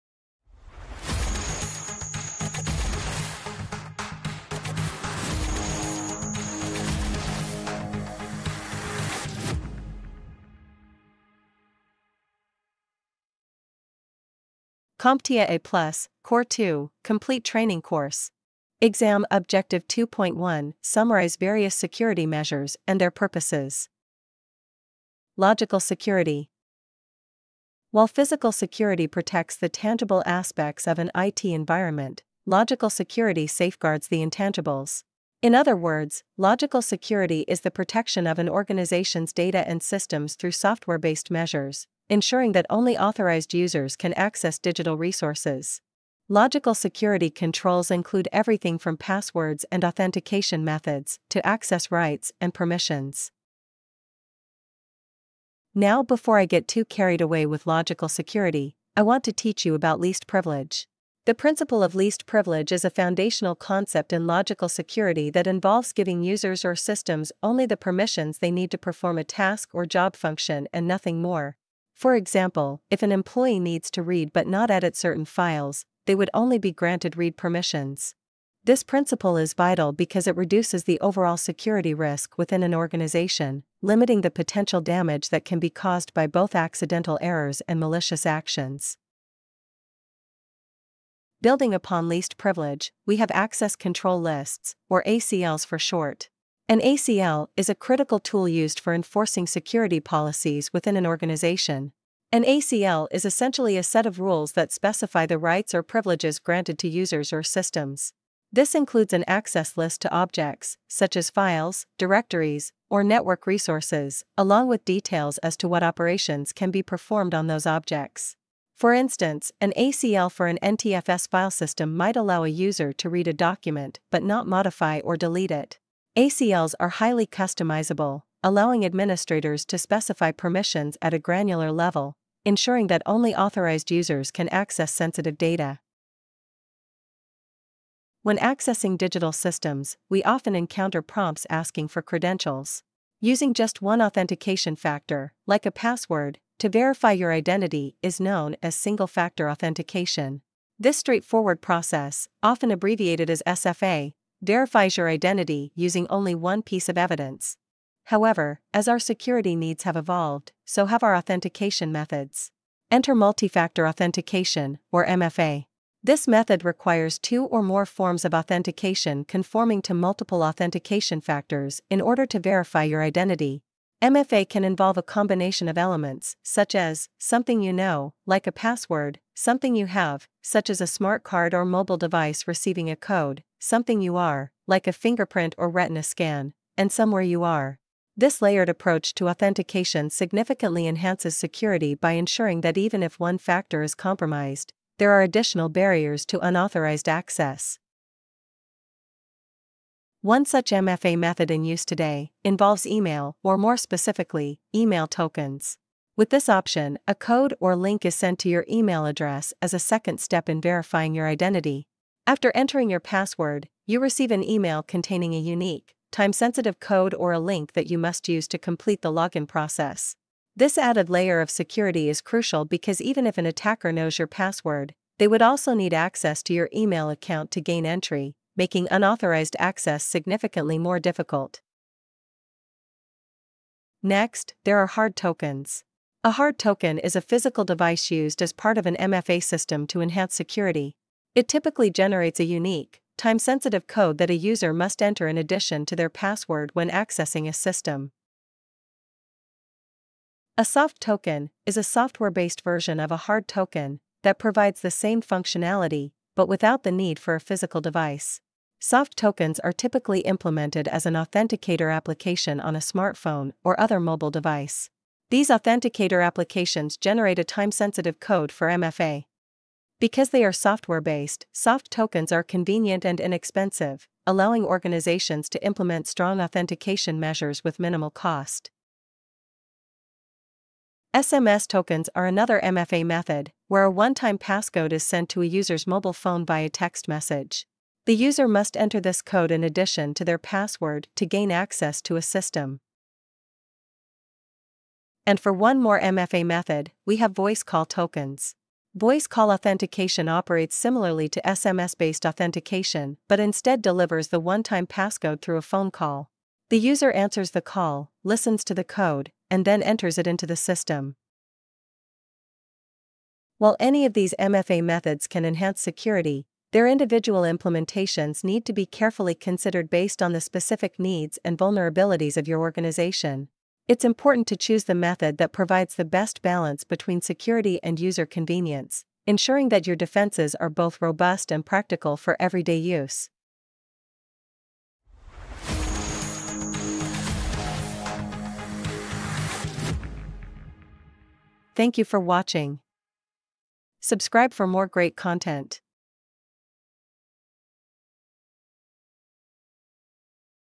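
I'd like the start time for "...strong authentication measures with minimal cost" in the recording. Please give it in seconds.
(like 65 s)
276 s.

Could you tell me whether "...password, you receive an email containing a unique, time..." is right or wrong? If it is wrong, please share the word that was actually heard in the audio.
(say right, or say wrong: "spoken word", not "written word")
right.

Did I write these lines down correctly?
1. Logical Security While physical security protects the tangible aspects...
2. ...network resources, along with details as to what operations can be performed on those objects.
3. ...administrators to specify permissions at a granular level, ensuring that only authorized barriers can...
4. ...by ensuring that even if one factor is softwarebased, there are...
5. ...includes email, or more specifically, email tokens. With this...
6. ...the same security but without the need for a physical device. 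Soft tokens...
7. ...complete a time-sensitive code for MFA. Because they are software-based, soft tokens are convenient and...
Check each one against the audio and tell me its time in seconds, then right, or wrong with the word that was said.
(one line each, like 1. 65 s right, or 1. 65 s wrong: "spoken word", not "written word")
1. 25 s right
2. 113 s right
3. 128 s wrong: "users", not "barriers"
4. 191 s wrong: "compromised", not "softwarebased"
5. 202 s wrong: "involves", not "includes"
6. 254 s wrong: "functionality", not "security"
7. 266 s wrong: "generate", not "complete".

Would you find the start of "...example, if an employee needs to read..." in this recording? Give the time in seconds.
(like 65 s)
72 s.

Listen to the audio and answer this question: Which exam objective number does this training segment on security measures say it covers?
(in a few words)
2.1.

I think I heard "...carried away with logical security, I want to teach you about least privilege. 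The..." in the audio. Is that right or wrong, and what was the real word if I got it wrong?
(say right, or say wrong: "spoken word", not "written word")
right.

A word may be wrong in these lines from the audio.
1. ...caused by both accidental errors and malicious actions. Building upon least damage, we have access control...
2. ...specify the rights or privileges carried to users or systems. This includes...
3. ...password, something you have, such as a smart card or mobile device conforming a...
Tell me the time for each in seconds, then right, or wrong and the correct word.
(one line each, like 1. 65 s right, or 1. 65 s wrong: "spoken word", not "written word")
1. 85 s wrong: "privilege", not "damage"
2. 104 s wrong: "granted", not "carried"
3. 178 s wrong: "receiving", not "conforming".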